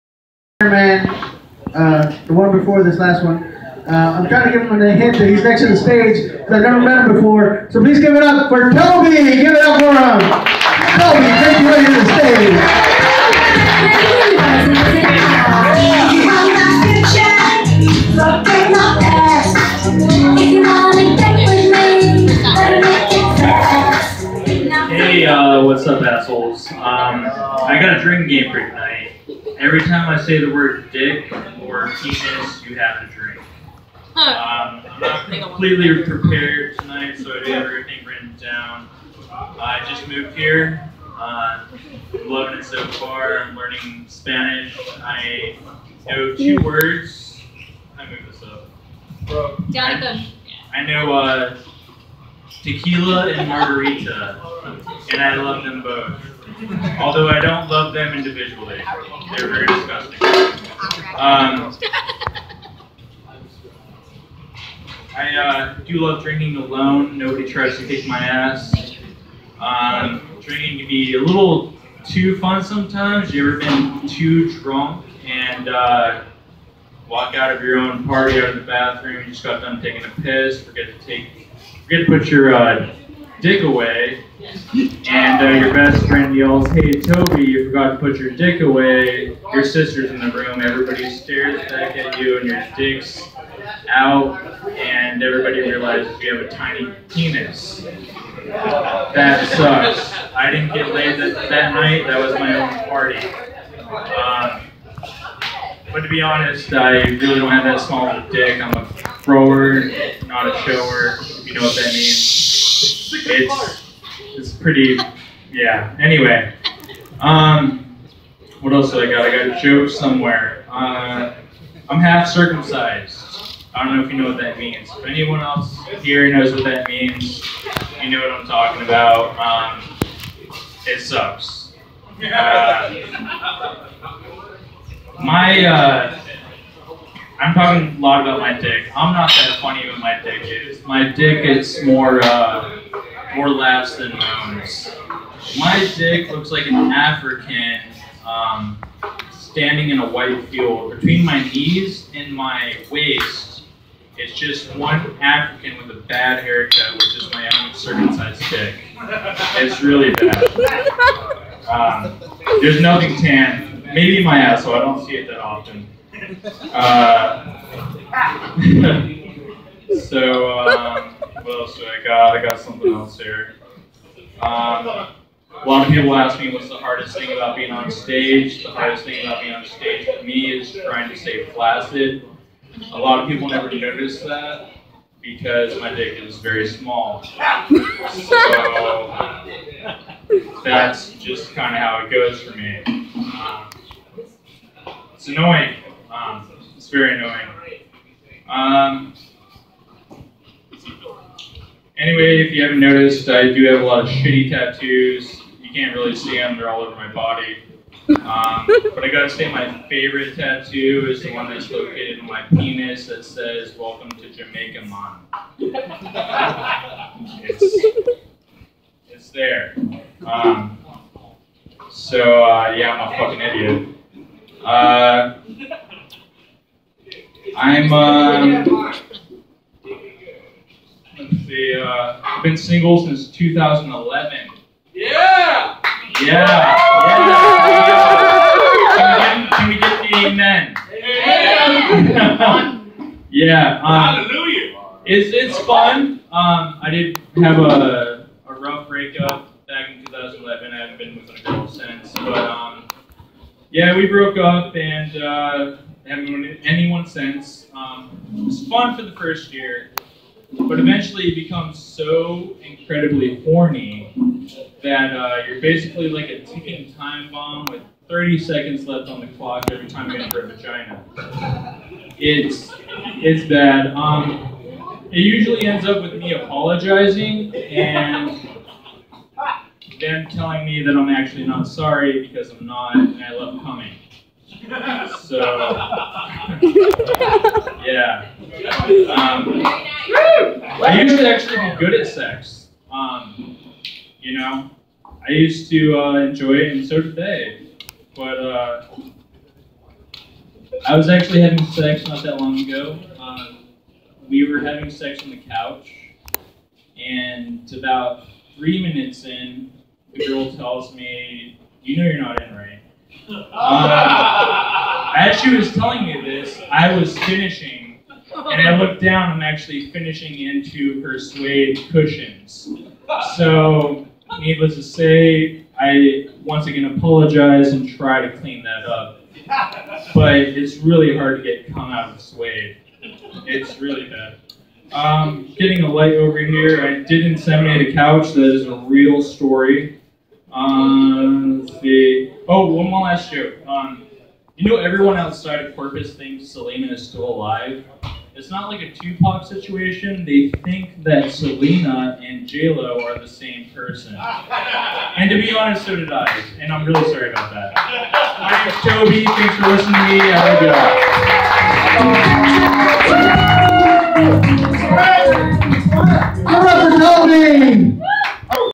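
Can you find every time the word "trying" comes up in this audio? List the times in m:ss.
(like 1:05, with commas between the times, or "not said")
0:04, 3:00.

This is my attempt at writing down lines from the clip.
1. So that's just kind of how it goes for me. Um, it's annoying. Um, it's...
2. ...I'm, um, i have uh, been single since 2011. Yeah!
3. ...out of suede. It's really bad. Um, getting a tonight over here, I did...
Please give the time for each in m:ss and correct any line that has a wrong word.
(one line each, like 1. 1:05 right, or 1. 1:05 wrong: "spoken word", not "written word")
1. 3:07 right
2. 3:47 right
3. 5:31 wrong: "light", not "tonight".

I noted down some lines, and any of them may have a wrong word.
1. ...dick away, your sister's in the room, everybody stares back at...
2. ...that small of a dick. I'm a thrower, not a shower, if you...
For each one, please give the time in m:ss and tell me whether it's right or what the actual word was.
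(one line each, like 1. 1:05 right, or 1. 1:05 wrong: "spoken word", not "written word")
1. 1:28 right
2. 1:47 right.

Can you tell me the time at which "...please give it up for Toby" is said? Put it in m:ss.
0:07.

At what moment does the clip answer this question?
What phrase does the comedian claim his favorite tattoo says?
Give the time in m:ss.
3:33.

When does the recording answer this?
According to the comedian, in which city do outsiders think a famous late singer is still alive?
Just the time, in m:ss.
5:45.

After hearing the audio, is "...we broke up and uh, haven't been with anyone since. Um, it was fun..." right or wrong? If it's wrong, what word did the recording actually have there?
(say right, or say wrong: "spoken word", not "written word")
right.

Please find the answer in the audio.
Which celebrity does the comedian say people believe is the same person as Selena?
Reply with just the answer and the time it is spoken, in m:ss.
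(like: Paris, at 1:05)
J Lo, at 5:52.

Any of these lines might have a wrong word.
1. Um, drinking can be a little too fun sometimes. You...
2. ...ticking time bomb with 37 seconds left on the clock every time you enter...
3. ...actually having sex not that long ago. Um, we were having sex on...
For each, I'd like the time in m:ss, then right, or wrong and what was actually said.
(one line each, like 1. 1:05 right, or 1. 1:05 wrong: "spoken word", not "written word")
1. 1:09 right
2. 4:26 wrong: "30", not "37"
3. 5:01 right.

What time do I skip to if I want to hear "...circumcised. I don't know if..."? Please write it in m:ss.
2:02.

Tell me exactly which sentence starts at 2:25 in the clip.
My dick looks like an African um, standing in a white field.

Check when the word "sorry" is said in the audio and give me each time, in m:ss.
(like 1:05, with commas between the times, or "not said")
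4:41, 5:57.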